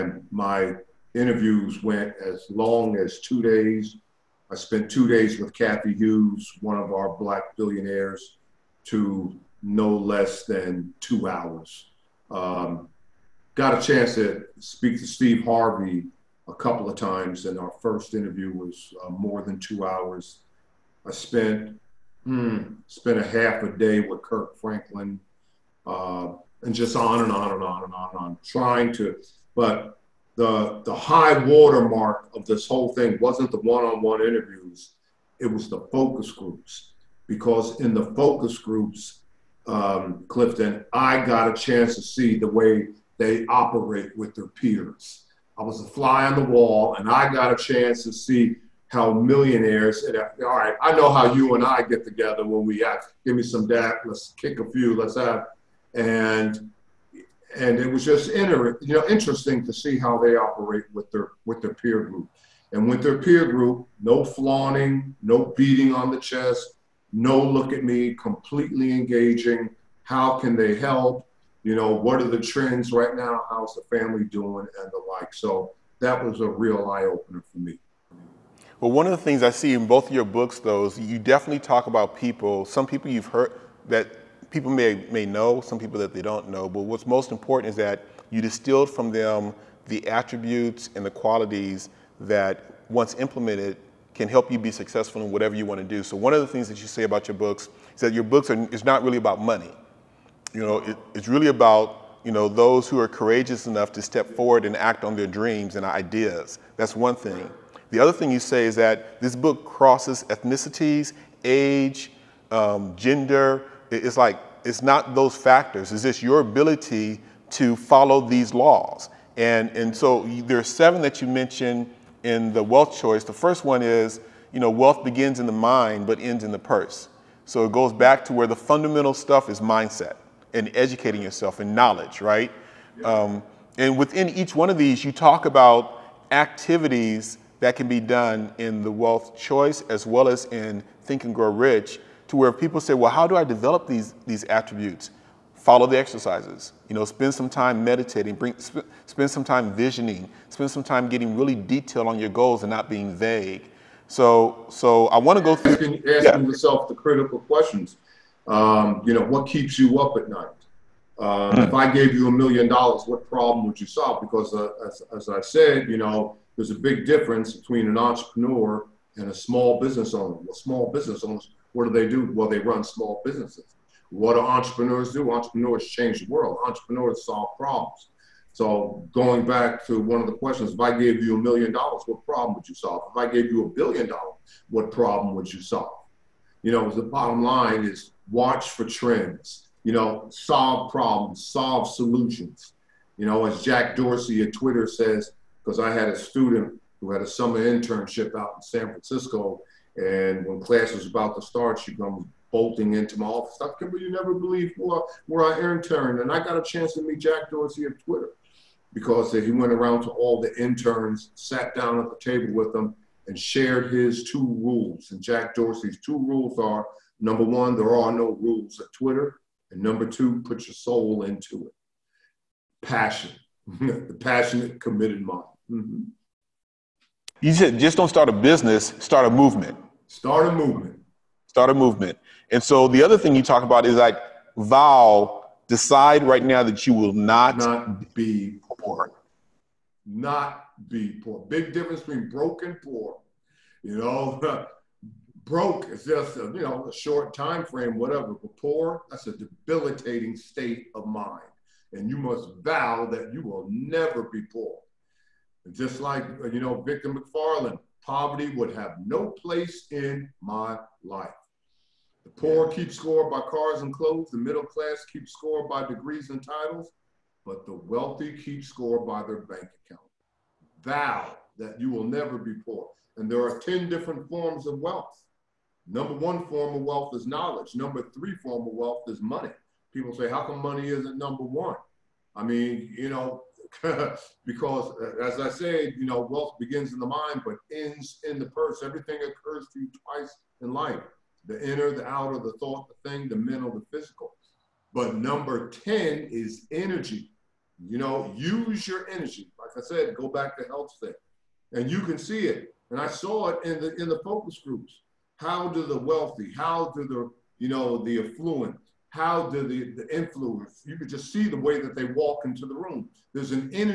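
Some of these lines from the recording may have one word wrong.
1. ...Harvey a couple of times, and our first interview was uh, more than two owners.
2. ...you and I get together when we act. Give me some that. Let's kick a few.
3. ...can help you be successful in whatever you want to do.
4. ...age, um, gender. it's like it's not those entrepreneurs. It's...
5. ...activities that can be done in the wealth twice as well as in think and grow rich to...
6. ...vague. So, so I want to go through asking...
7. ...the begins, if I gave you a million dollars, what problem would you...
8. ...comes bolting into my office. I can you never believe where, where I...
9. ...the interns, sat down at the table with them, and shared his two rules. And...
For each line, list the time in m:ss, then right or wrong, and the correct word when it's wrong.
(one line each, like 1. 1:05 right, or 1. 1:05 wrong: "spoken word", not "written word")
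1. 0:15 wrong: "hours", not "owners"
2. 0:51 right
3. 1:34 right
4. 1:51 wrong: "factors", not "entrepreneurs"
5. 2:16 wrong: "choice", not "twice"
6. 2:33 right
7. 3:00 wrong: "questions", not "begins"
8. 3:21 right
9. 3:30 right.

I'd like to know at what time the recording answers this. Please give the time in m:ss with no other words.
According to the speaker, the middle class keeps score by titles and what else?
4:25.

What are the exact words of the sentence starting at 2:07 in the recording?
So it goes back to where the fundamental stuff is mindset and educating yourself and knowledge, right?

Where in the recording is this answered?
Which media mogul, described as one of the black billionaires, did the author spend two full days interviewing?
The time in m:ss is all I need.
0:05.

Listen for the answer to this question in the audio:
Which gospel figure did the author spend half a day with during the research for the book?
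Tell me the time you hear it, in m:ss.
0:24.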